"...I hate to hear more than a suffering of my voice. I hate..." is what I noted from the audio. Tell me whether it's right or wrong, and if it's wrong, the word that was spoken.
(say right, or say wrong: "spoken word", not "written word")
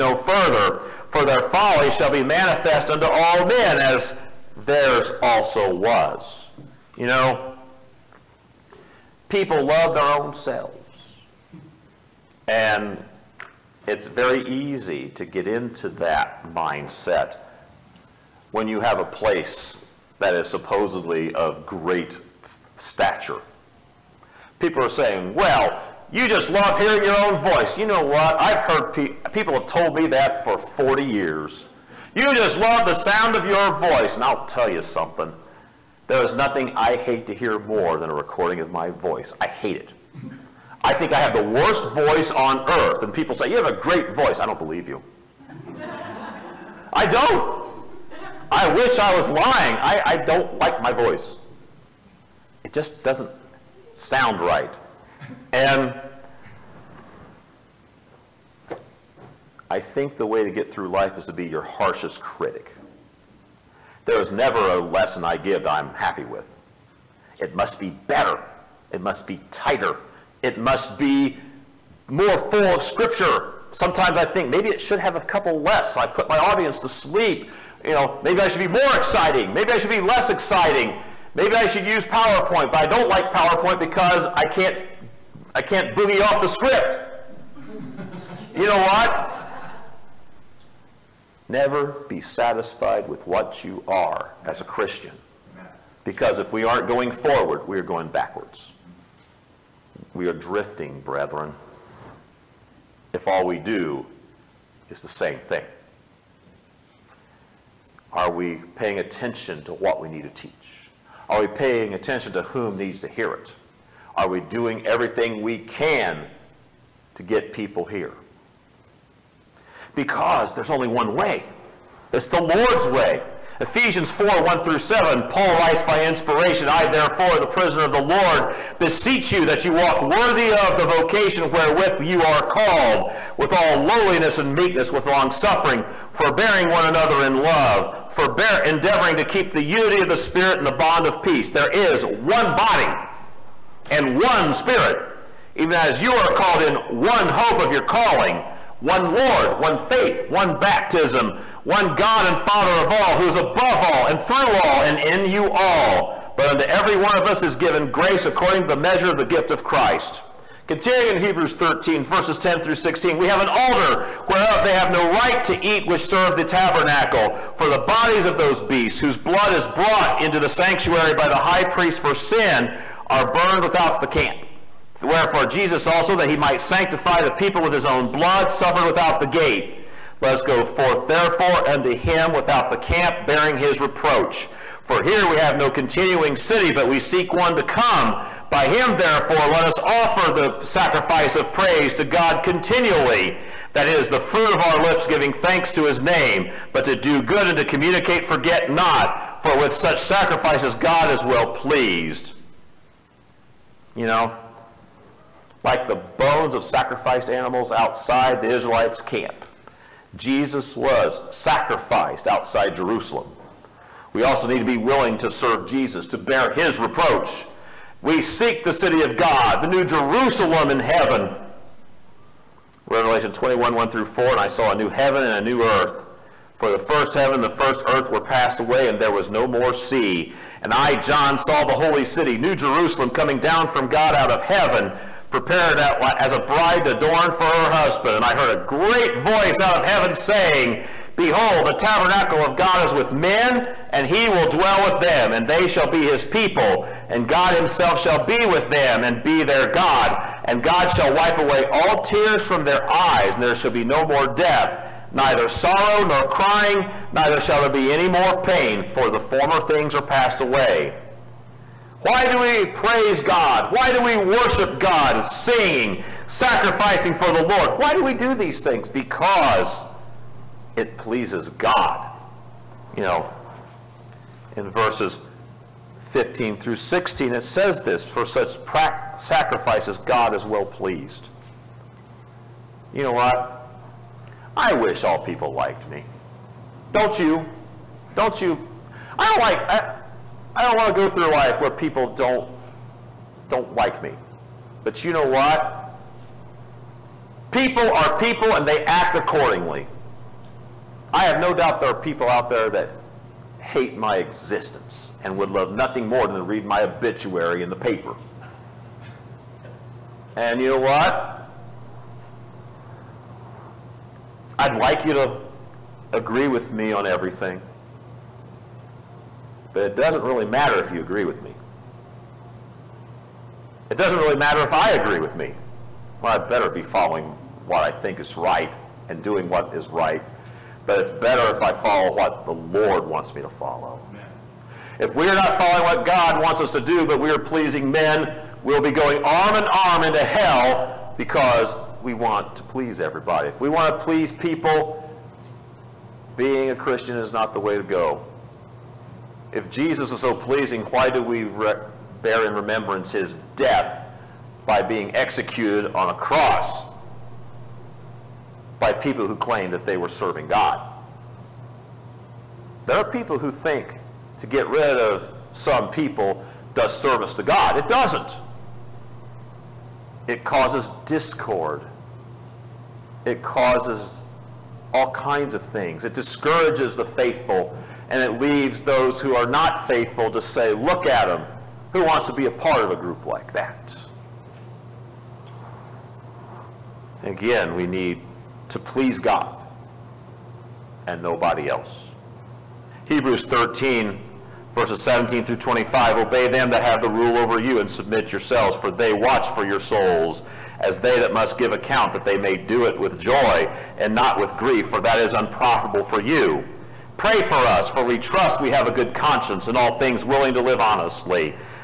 wrong: "recording", not "suffering".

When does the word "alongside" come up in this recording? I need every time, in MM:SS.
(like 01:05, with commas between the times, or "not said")
not said.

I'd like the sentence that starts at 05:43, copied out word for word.
If we want to please people, being a Christian is not the way to go.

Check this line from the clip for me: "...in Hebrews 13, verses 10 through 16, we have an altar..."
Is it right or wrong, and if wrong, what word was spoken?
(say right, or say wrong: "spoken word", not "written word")
right.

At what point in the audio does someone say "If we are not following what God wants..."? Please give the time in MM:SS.
05:34.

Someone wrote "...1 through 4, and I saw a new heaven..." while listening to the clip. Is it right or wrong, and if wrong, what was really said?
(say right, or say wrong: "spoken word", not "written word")
right.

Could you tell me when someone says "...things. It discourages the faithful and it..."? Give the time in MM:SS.
06:15.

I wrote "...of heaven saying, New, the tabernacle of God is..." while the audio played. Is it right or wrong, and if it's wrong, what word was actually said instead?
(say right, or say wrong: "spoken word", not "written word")
wrong: "Behold", not "New".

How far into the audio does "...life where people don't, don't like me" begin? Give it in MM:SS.
04:51.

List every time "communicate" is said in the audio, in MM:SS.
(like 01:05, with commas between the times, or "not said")
03:17.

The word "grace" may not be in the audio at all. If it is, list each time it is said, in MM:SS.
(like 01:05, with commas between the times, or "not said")
02:37.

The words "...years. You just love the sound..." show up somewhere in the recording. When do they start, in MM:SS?
00:31.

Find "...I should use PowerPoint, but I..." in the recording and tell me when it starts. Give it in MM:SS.
01:21.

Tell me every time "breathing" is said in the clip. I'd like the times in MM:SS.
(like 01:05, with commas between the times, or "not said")
not said.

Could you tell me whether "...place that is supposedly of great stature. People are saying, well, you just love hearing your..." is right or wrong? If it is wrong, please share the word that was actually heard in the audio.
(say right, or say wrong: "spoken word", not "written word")
right.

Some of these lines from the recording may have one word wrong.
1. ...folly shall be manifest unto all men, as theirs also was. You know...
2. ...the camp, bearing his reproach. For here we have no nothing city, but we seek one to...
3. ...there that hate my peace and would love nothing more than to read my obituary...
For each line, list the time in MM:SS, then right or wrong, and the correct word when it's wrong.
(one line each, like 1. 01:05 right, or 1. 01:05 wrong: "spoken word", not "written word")
1. 00:01 right
2. 03:02 wrong: "continuing", not "nothing"
3. 05:02 wrong: "existence", not "peace".